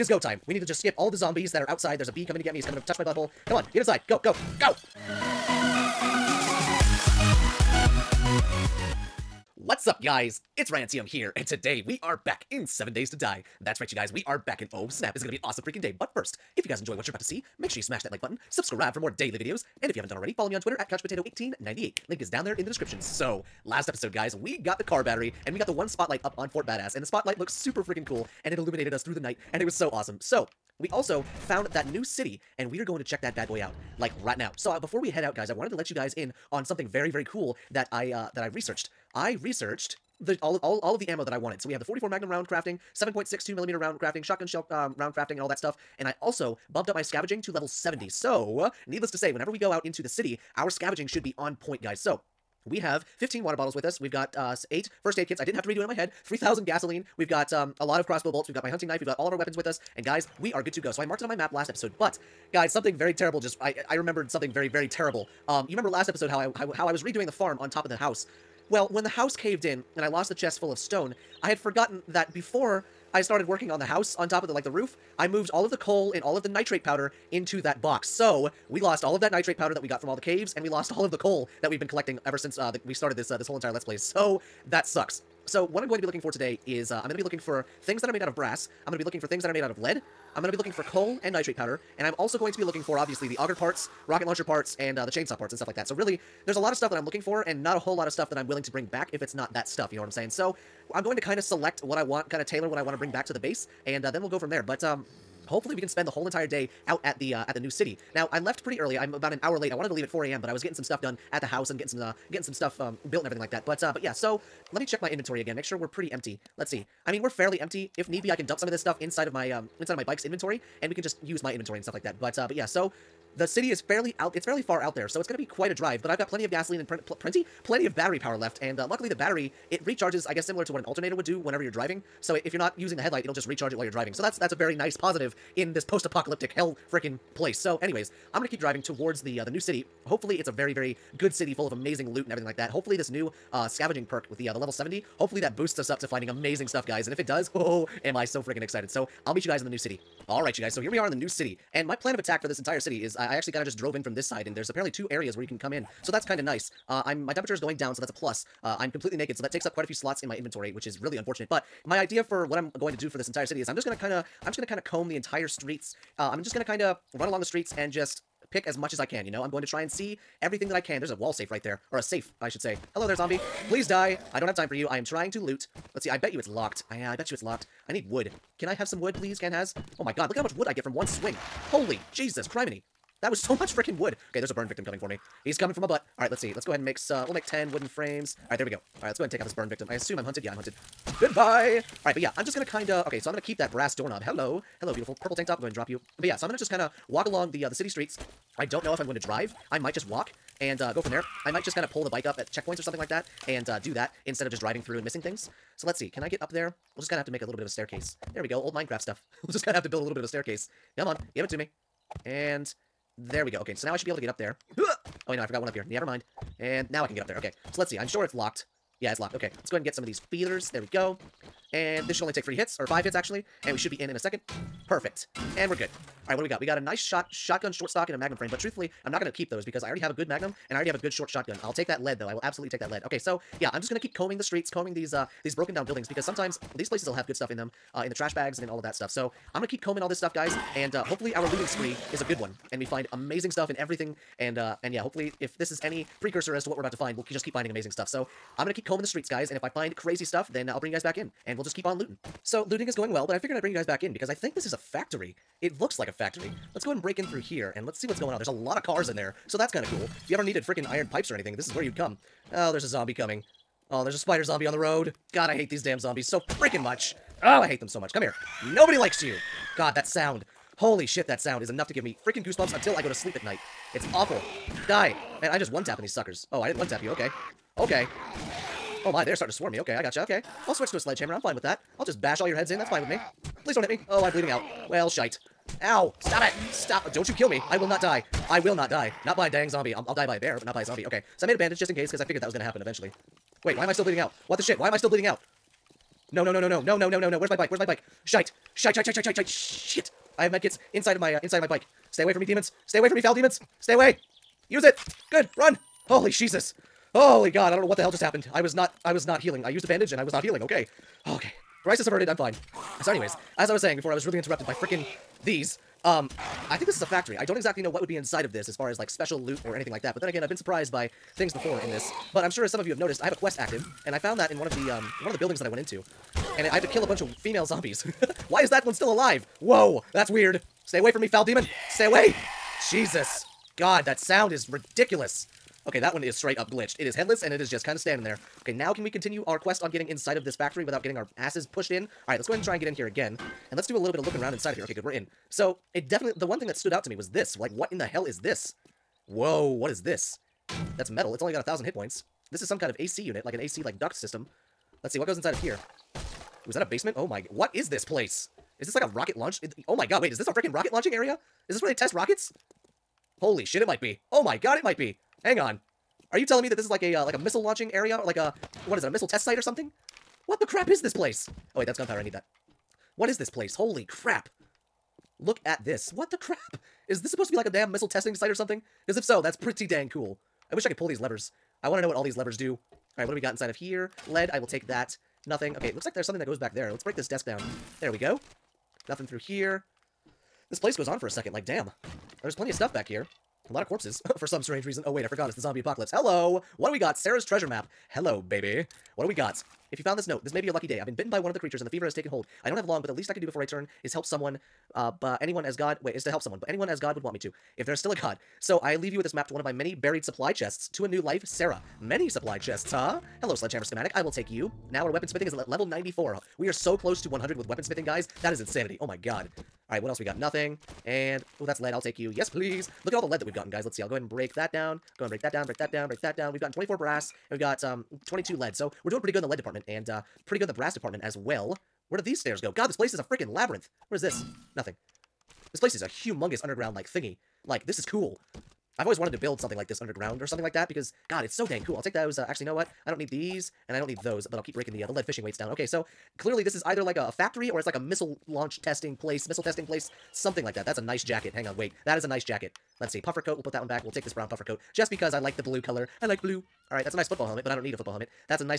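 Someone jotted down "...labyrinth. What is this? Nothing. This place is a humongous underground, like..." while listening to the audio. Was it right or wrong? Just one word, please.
right.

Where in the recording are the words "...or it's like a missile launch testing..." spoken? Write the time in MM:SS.
07:27.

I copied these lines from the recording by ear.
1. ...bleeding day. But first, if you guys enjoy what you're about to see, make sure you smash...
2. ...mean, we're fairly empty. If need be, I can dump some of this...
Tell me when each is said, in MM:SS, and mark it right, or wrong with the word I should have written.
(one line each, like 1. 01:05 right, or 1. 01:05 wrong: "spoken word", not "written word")
1. 00:15 wrong: "freaking", not "bleeding"
2. 01:57 right.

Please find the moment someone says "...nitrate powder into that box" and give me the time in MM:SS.
01:16.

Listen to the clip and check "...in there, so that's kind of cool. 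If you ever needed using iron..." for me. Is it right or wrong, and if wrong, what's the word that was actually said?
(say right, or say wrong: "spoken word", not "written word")
wrong: "freaking", not "using".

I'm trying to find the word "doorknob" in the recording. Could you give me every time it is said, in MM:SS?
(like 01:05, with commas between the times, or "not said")
03:13.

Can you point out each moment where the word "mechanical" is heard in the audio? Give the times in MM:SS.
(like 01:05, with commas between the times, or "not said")
not said.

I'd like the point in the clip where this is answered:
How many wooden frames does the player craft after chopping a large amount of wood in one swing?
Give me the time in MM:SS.
03:07.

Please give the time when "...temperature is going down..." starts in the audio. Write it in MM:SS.
02:37.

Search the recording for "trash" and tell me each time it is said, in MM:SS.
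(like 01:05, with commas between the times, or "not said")
03:58.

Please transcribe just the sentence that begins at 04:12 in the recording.
So, looting is going well, but I figured I'd bring you guys back in because I think this is a factory.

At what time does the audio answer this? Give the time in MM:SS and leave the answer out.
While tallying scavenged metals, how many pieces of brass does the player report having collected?
07:06.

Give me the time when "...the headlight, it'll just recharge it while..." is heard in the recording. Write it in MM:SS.
02:12.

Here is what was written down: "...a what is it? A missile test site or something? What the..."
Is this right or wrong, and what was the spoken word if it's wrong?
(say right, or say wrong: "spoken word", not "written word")
right.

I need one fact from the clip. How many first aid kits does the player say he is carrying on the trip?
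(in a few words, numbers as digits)
8.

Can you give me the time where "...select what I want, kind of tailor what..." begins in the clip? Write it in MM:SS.
01:41.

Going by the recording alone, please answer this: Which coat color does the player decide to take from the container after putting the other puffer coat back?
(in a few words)
Brown.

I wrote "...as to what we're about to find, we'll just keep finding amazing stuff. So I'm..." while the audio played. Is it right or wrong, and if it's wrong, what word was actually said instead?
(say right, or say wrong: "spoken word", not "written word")
right.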